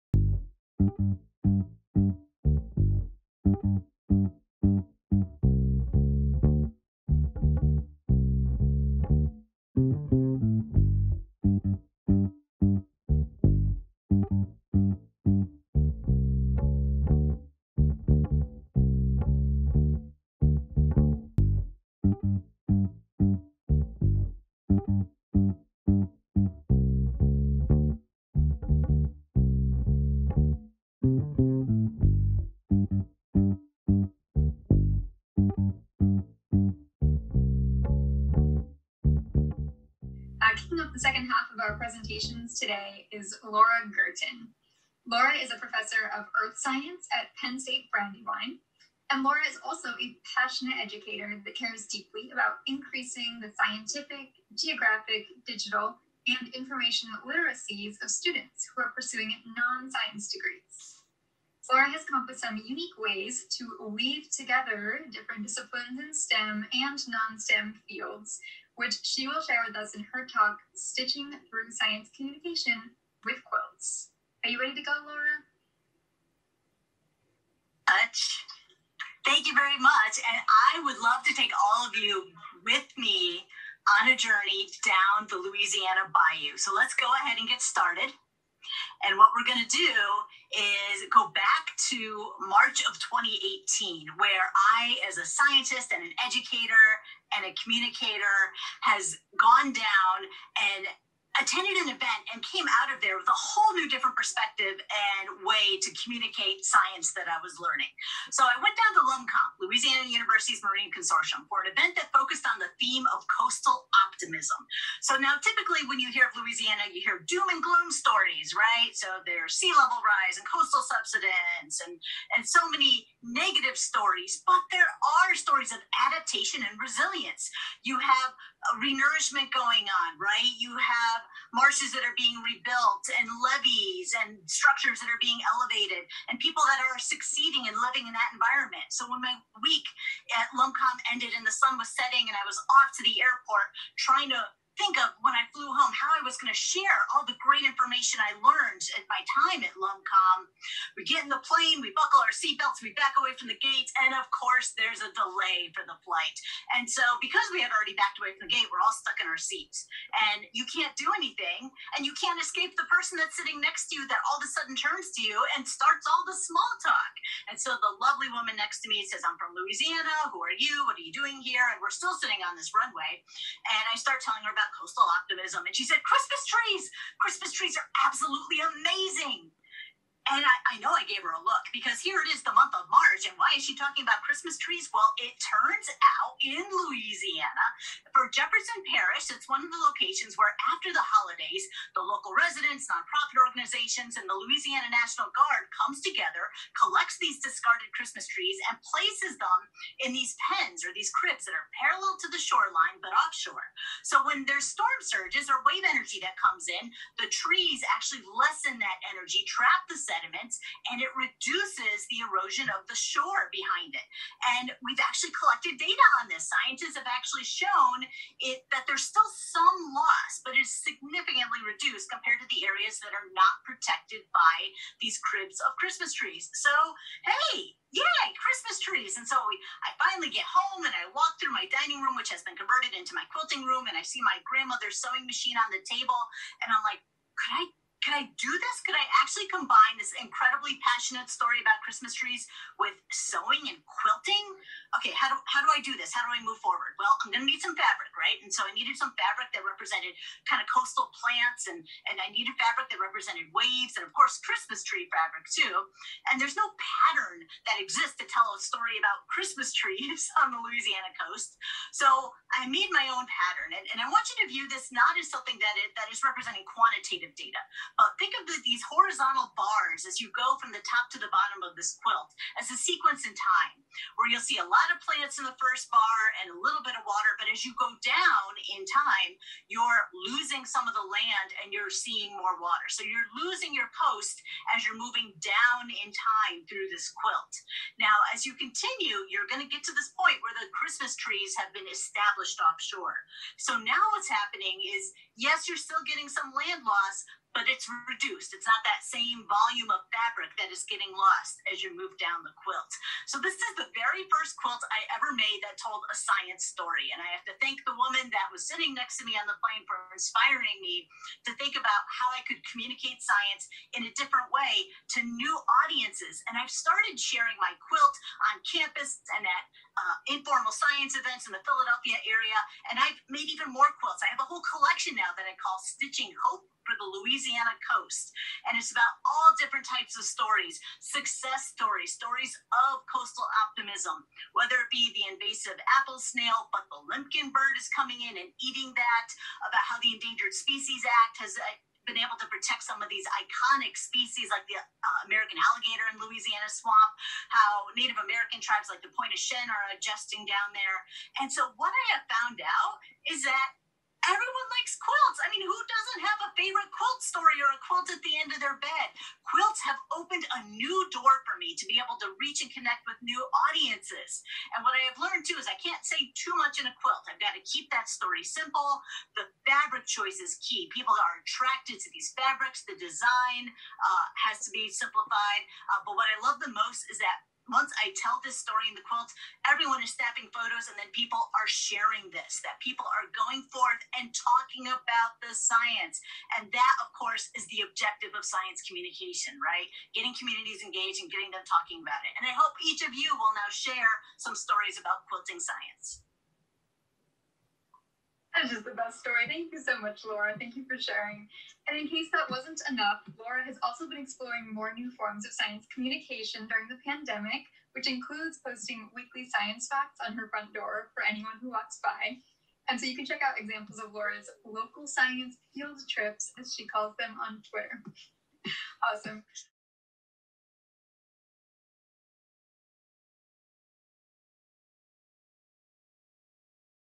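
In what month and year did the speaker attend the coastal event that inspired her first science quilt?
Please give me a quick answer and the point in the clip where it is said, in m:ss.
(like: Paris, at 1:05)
March 2018, at 1:32.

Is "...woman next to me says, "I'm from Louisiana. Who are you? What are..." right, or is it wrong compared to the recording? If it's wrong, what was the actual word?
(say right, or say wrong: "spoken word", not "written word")
right.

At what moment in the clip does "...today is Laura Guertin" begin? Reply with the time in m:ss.
0:42.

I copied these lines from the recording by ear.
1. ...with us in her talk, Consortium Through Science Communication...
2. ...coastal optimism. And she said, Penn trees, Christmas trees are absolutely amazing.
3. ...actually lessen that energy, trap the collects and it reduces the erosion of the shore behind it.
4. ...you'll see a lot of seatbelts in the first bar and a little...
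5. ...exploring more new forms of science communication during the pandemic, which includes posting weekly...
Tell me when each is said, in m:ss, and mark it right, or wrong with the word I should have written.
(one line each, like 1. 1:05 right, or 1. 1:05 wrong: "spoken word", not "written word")
1. 1:09 wrong: "Stitching", not "Consortium"
2. 2:54 wrong: "Christmas", not "Penn"
3. 3:27 wrong: "sediments", not "collects"
4. 4:34 wrong: "plants", not "seatbelts"
5. 6:44 right.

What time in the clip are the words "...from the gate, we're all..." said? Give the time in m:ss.
2:38.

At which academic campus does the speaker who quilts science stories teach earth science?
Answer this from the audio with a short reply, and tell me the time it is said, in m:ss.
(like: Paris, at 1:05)
Penn State Brandywine, at 0:47.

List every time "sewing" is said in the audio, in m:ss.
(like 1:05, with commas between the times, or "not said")
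3:55, 4:03.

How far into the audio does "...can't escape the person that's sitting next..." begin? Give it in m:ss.
2:42.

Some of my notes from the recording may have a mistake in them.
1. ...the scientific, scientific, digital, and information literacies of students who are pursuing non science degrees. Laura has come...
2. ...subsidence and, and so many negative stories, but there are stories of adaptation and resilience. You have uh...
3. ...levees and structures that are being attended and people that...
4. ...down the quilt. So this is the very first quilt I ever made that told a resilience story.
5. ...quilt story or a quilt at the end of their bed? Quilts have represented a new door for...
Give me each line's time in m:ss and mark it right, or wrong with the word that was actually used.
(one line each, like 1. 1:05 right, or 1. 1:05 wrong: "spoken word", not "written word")
1. 0:53 wrong: "geographic", not "scientific"
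2. 2:00 right
3. 2:13 wrong: "elevated", not "attended"
4. 5:02 wrong: "science", not "resilience"
5. 5:56 wrong: "opened", not "represented".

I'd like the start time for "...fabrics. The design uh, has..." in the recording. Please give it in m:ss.
6:12.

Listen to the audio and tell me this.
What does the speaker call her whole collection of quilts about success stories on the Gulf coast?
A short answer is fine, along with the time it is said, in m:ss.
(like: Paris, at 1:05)
Stitching Hope, at 5:25.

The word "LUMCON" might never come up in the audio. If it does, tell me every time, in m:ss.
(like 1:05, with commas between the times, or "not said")
1:49, 2:20, 2:29.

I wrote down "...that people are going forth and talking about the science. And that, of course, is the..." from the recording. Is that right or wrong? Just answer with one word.
right.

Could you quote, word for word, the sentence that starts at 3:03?
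And why is she talking about Christmas trees?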